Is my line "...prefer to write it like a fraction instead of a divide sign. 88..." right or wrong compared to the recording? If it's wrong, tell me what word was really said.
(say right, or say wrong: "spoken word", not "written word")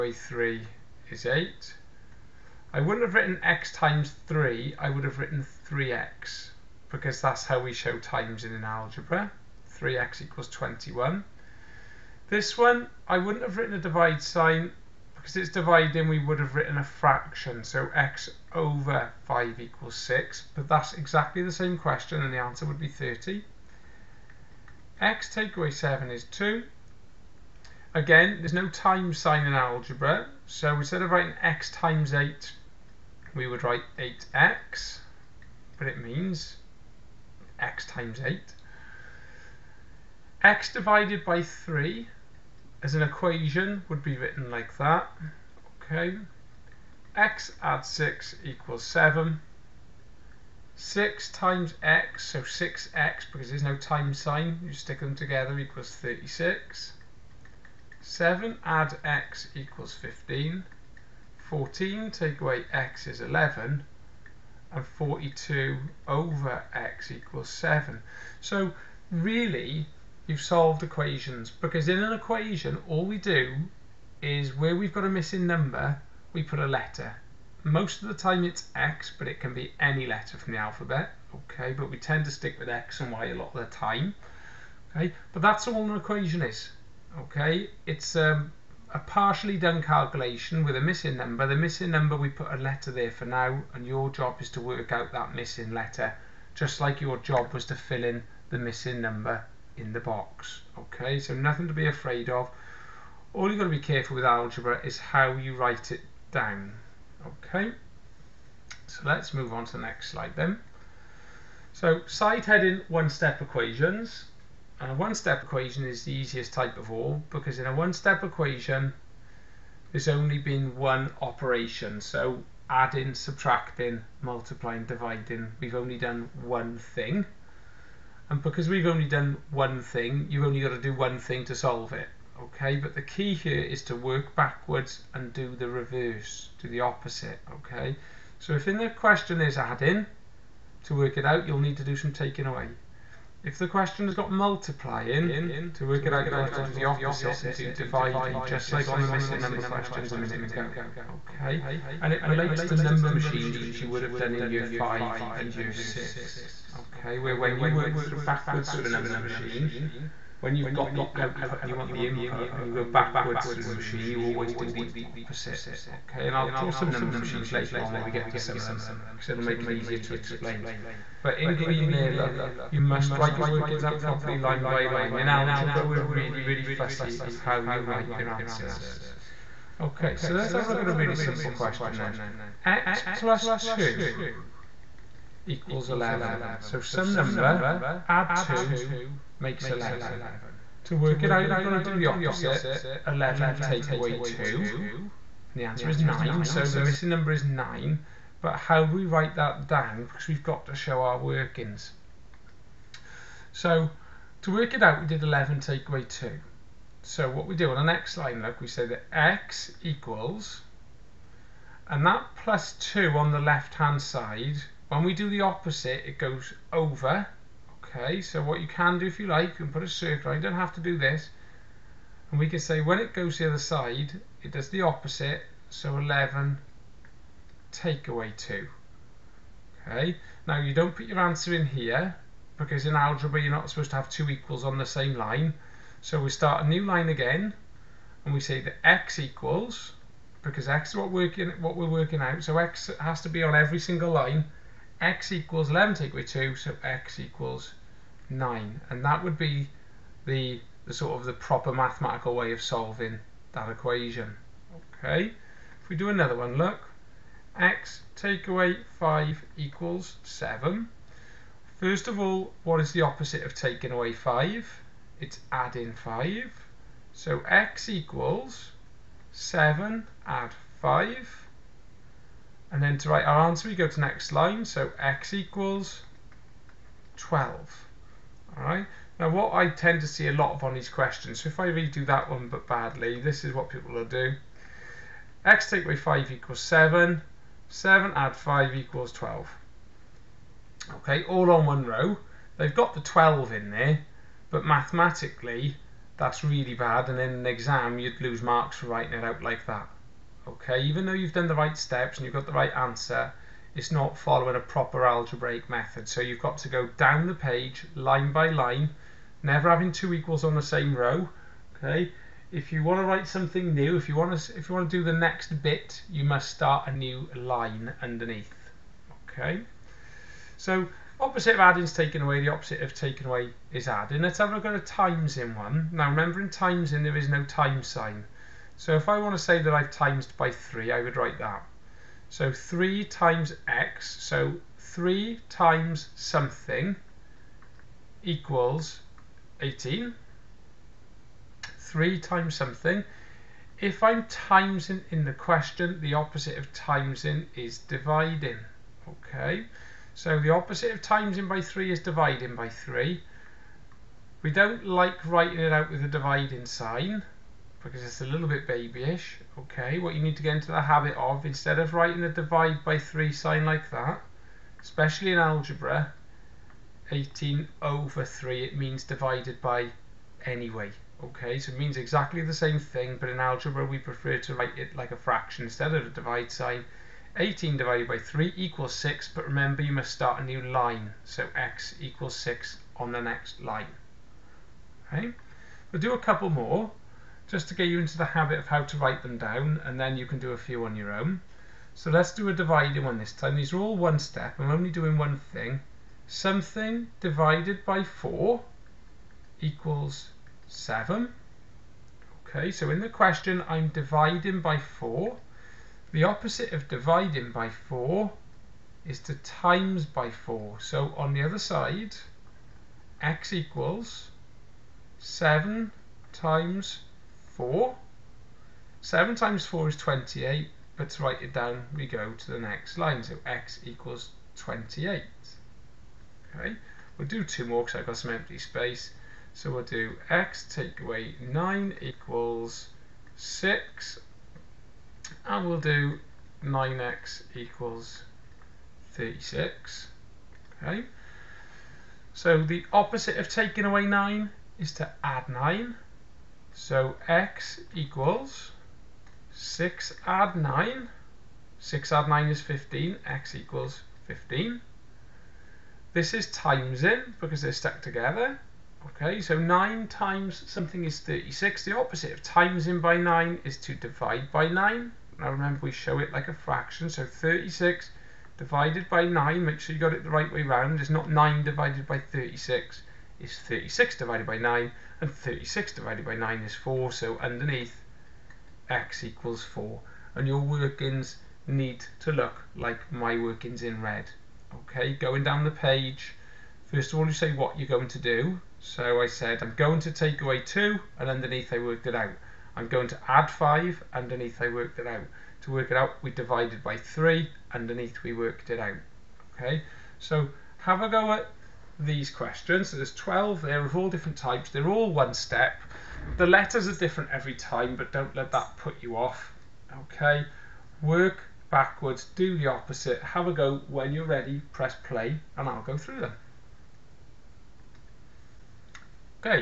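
wrong: "18", not "88".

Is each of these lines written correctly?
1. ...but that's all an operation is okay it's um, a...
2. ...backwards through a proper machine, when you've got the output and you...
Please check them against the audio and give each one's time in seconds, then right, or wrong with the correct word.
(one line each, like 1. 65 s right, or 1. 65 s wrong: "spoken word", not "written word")
1. 85 s wrong: "equation", not "operation"
2. 158 s wrong: "number", not "proper".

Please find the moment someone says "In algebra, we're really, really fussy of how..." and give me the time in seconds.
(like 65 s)
175 s.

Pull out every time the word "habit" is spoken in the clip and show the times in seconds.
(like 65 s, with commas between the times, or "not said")
360 s, 388 s.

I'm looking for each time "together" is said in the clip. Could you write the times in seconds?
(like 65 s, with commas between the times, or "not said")
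55 s, 458 s.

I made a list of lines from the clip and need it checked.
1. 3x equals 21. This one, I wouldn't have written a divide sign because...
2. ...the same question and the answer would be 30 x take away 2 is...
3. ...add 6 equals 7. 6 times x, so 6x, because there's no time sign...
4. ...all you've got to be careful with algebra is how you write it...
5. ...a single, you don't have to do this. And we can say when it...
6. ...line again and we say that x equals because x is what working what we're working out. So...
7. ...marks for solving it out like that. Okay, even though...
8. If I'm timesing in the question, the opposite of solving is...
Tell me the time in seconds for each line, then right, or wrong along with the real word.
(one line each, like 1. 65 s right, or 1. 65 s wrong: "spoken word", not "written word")
1. 9 s right
2. 21 s wrong: "7", not "2"
3. 47 s right
4. 103 s right
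5. 219 s wrong: "circle", not "single"
6. 236 s right
7. 298 s wrong: "writing", not "solving"
8. 343 s wrong: "timesing", not "solving".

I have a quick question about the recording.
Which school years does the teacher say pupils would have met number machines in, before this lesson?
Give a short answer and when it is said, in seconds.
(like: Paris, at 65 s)
year 5 and year 6, at 154 s.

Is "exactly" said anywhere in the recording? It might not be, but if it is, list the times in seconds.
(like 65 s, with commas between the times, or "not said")
20 s, 371 s.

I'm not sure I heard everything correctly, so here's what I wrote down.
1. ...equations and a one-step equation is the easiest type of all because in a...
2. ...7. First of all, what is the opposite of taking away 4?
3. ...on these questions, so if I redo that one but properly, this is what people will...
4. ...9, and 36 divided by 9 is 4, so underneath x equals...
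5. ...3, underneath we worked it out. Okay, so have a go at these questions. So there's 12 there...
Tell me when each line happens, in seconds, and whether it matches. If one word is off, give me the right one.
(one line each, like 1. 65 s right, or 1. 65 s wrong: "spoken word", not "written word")
1. 113 s right
2. 260 s wrong: "5", not "4"
3. 280 s wrong: "badly", not "properly"
4. 474 s right
5. 496 s right.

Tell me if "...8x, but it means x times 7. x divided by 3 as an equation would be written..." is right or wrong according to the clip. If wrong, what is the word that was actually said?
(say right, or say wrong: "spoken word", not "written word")
wrong: "8", not "7".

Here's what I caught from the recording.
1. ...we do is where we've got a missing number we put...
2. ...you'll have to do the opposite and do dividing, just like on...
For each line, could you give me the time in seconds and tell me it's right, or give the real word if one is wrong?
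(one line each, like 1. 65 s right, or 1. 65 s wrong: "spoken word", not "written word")
1. 73 s right
2. 146 s right.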